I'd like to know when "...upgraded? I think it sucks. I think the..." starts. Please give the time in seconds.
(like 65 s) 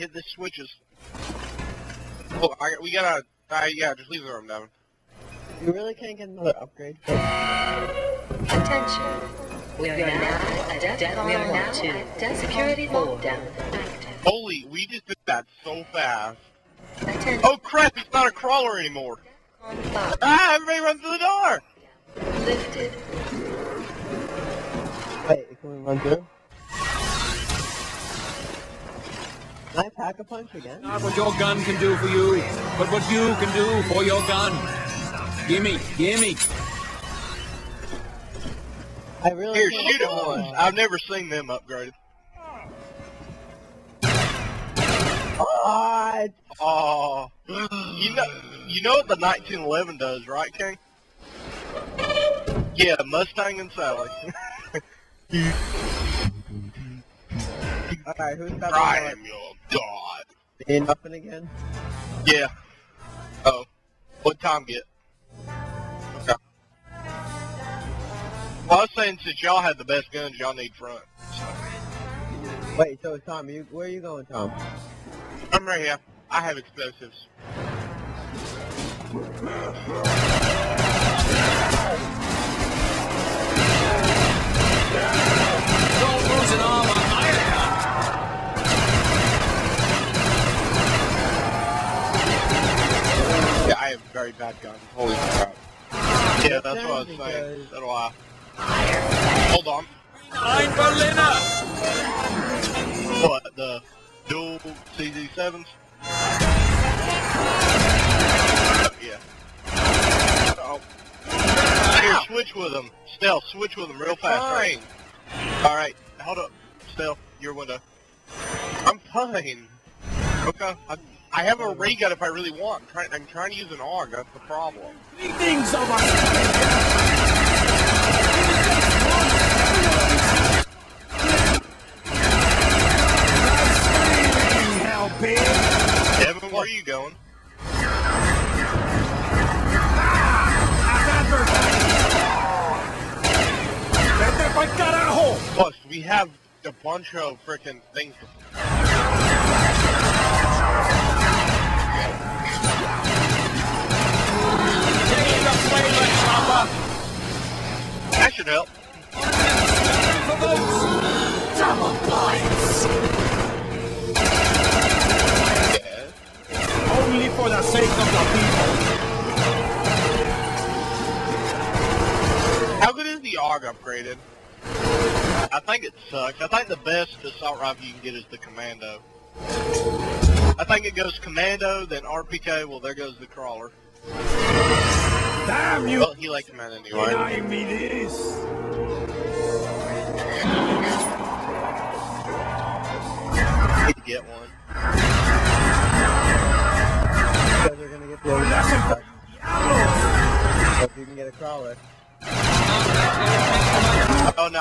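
173 s.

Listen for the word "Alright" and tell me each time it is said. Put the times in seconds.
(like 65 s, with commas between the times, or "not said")
58 s, 115 s.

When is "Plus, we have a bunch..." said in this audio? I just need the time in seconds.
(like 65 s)
145 s.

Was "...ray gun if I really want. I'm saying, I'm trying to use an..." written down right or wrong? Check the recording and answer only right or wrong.
wrong.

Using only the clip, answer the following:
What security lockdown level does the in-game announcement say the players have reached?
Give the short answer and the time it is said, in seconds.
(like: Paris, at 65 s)
DEF, at 10 s.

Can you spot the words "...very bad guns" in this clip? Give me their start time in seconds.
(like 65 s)
94 s.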